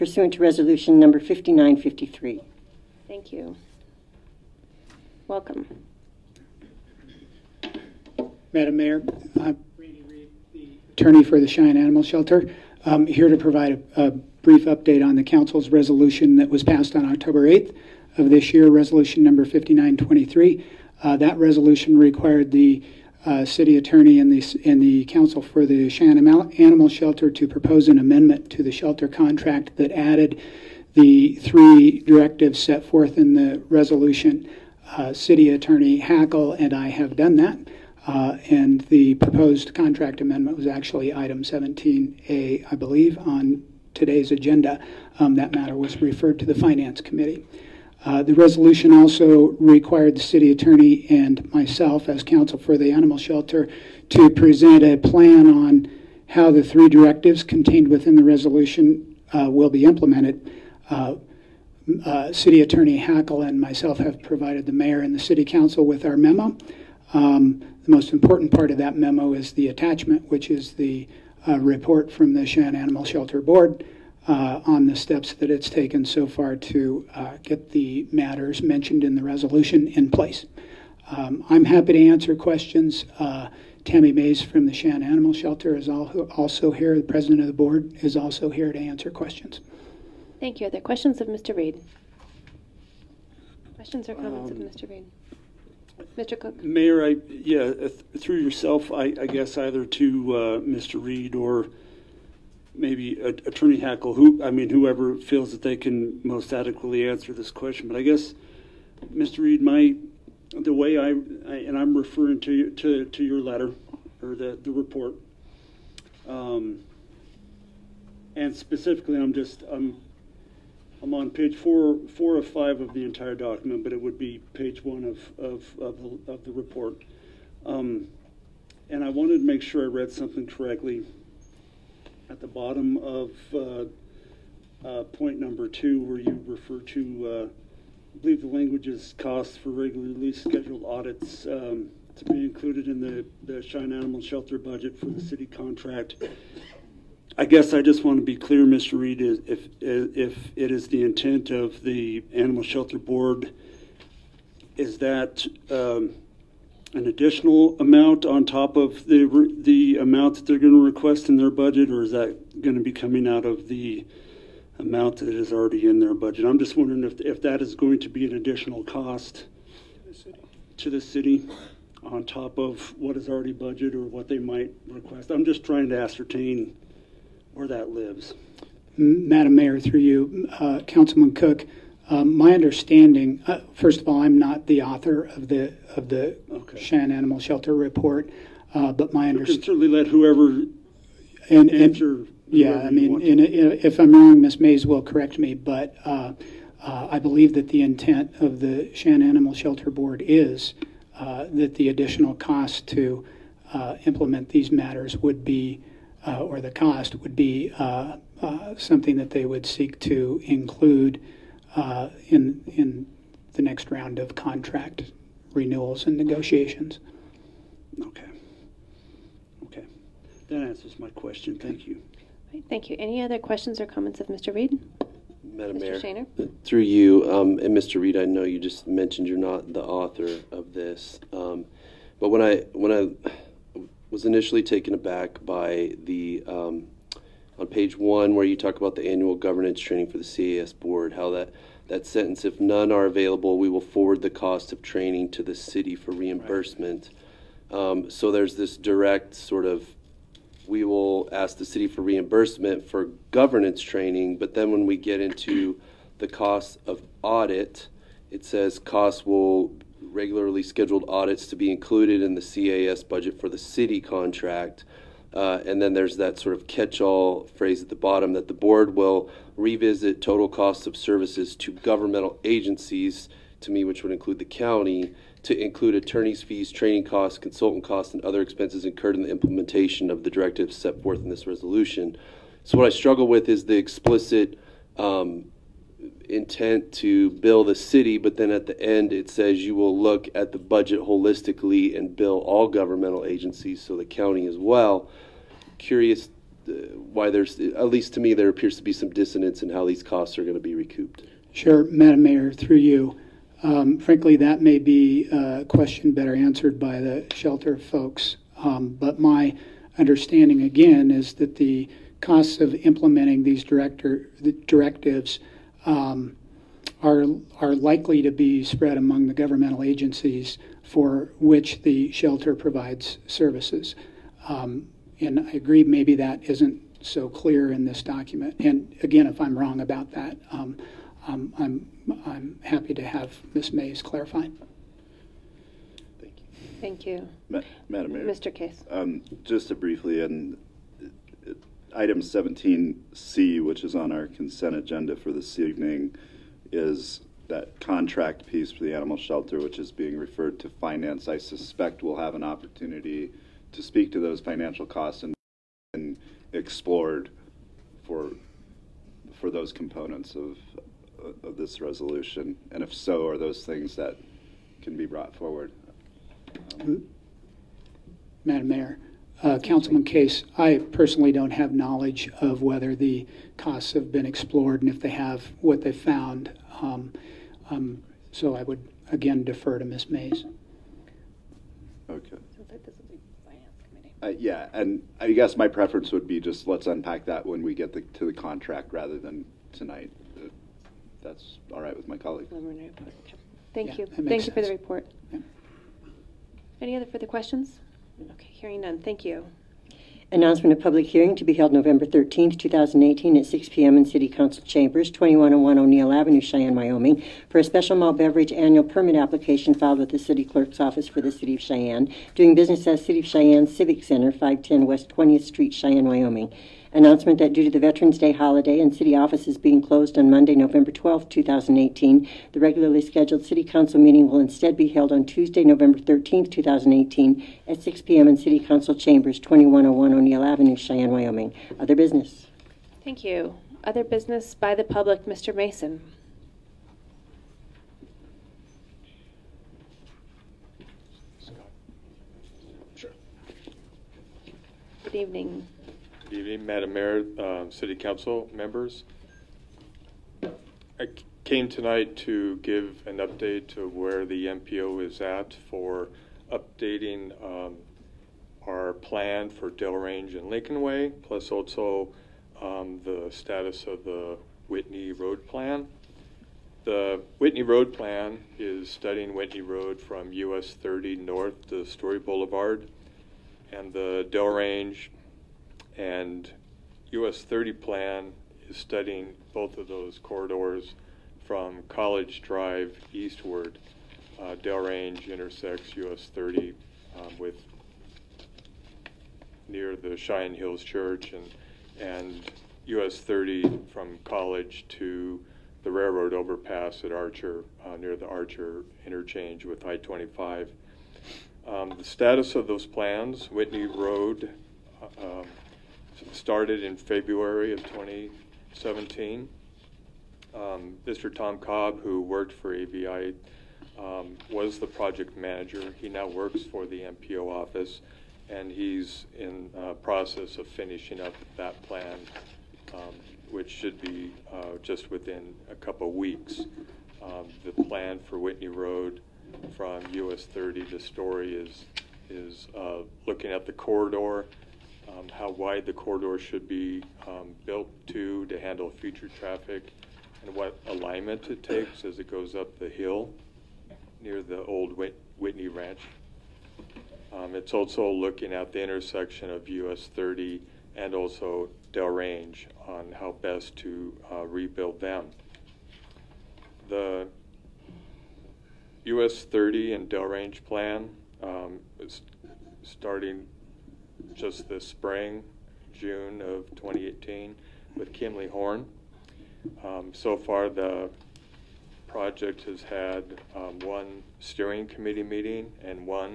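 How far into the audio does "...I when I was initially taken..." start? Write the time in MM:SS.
03:52.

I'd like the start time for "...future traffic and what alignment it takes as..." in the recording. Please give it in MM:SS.
08:58.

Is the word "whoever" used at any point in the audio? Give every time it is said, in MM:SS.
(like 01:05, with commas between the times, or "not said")
01:44, 03:10.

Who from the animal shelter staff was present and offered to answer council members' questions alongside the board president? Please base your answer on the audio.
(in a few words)
Tammy Mays.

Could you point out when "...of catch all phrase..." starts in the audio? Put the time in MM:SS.
04:26.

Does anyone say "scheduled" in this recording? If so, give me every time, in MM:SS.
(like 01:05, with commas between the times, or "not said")
02:20, 04:20, 07:03.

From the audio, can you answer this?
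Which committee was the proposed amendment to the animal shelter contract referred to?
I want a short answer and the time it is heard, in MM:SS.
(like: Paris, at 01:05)
Finance Committee, at 00:46.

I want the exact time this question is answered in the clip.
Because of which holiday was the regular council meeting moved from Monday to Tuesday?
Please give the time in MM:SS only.
06:57.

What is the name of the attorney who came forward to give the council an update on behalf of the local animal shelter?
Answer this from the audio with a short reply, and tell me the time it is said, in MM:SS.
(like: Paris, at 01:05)
Randy Reed, at 00:09.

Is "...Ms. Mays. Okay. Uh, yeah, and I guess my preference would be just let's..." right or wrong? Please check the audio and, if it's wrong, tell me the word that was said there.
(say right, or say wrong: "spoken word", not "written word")
right.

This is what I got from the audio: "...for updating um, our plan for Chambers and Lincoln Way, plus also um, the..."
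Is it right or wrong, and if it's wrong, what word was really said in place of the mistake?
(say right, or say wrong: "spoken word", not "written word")
wrong: "Range", not "Chambers".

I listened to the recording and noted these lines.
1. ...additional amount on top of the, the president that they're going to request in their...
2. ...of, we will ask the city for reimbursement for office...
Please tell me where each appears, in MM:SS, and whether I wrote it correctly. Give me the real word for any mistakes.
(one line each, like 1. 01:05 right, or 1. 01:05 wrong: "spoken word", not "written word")
1. 02:37 wrong: "amount", not "president"
2. 04:09 wrong: "governance", not "office".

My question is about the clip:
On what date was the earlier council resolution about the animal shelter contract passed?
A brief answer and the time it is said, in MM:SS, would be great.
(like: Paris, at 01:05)
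October 8th, at 00:17.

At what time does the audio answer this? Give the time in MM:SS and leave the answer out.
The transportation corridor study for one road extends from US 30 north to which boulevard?
07:51.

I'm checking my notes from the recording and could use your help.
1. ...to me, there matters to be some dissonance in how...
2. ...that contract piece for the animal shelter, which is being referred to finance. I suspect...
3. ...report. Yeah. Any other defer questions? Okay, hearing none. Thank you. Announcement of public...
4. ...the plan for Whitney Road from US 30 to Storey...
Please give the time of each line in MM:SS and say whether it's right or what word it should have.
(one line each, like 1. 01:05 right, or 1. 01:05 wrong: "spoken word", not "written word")
1. 04:58 wrong: "appears", not "matters"
2. 05:47 right
3. 06:34 wrong: "further", not "defer"
4. 08:47 right.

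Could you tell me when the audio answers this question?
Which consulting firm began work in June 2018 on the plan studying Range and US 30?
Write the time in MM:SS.
09:28.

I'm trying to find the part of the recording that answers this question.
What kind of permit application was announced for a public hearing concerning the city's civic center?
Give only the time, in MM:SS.
06:47.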